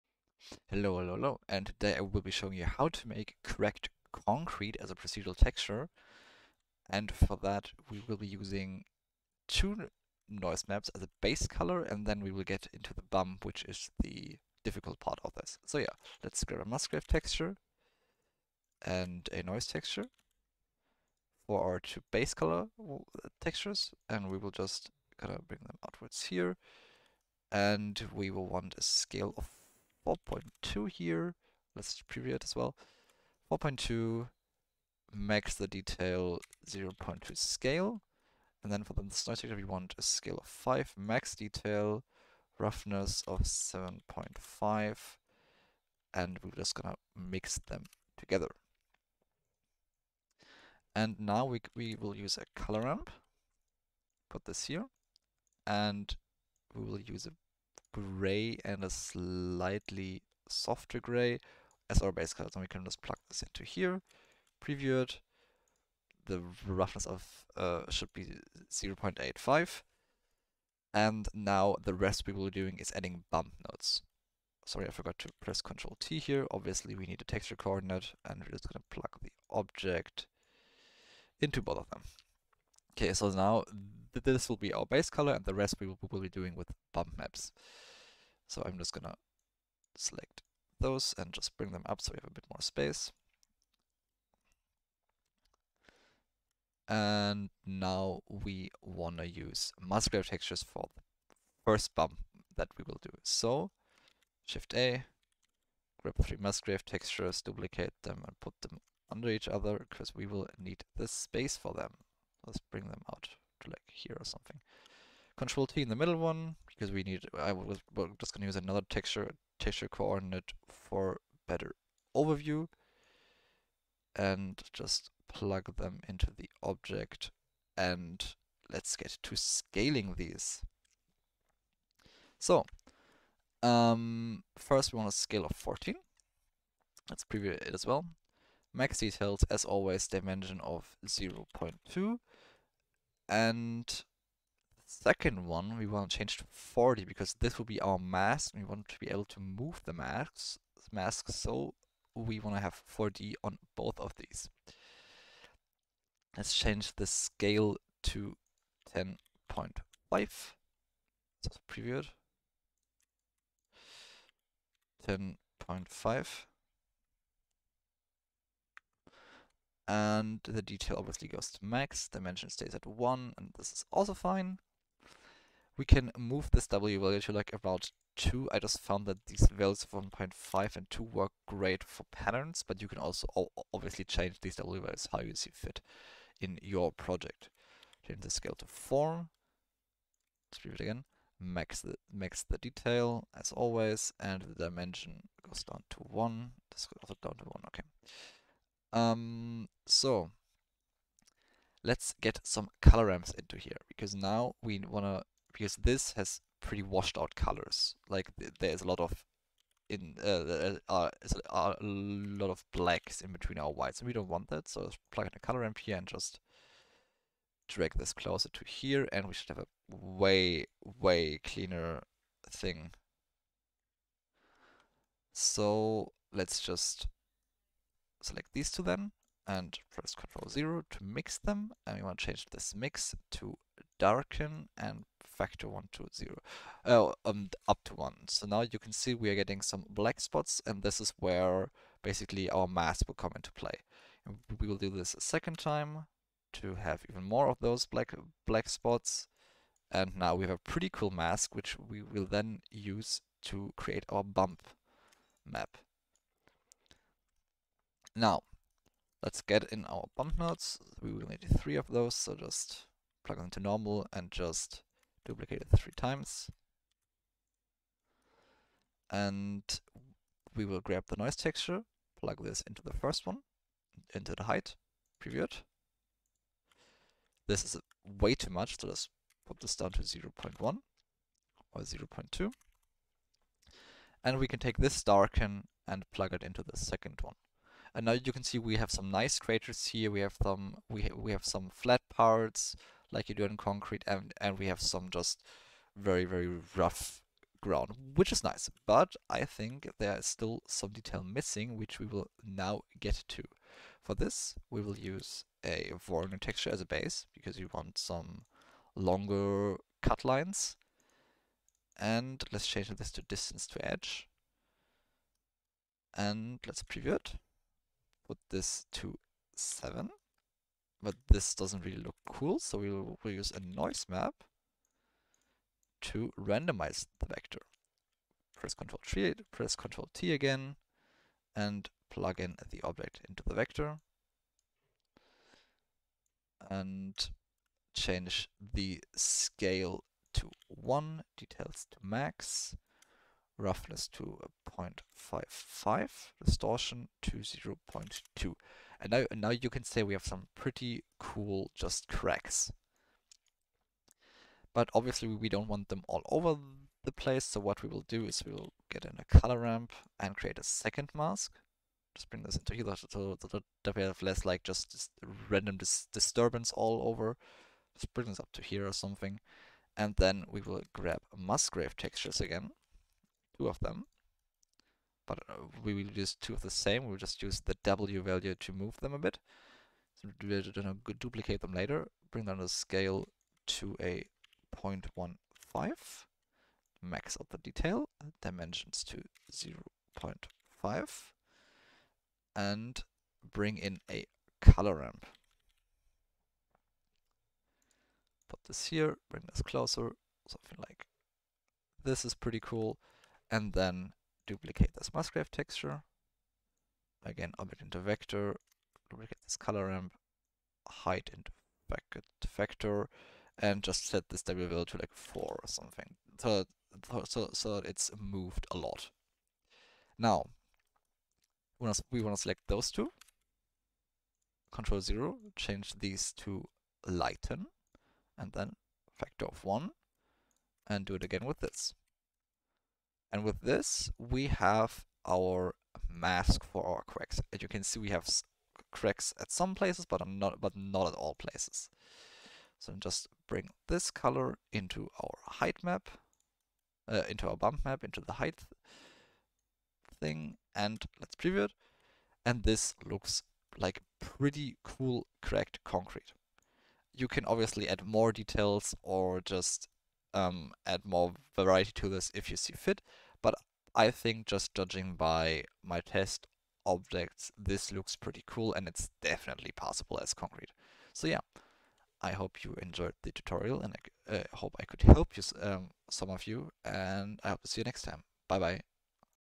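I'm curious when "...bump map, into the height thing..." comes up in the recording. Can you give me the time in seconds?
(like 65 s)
447 s.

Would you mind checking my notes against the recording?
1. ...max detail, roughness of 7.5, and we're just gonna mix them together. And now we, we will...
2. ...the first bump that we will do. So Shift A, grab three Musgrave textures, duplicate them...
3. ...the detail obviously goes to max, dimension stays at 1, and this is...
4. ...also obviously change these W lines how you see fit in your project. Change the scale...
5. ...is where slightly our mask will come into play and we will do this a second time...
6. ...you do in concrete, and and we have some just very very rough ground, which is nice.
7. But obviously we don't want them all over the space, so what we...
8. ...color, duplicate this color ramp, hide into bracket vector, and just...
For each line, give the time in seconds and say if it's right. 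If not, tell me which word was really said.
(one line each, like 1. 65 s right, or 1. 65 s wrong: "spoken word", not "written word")
1. 40 s right
2. 100 s right
3. 170 s right
4. 182 s wrong: "values", not "lines"
5. 241 s wrong: "basically", not "slightly"
6. 293 s right
7. 354 s wrong: "place", not "space"
8. 407 s wrong: "vector", not "color".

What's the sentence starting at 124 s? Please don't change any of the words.
And just plug them into the object and let's get to scaling these.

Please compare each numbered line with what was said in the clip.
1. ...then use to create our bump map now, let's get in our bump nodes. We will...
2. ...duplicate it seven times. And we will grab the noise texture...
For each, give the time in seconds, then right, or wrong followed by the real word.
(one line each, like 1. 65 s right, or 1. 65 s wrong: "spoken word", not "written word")
1. 252 s right
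2. 265 s wrong: "three", not "seven".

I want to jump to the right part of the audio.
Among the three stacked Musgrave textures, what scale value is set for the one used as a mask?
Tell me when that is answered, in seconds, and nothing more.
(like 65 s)
146 s.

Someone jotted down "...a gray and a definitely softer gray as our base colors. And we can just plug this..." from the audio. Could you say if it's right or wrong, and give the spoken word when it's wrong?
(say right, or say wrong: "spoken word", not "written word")
wrong: "slightly", not "definitely".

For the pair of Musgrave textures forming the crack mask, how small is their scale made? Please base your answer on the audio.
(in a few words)
0.15.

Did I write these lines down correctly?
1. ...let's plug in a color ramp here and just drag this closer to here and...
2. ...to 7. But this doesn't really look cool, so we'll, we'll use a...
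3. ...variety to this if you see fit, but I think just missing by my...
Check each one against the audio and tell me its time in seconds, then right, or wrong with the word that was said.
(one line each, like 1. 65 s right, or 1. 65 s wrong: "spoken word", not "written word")
1. 214 s right
2. 318 s right
3. 461 s wrong: "judging", not "missing".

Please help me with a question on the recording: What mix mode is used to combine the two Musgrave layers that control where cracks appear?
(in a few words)
lighten.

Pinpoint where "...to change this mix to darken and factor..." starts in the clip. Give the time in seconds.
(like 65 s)
232 s.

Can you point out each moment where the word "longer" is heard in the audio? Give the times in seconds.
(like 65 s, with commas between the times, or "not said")
308 s.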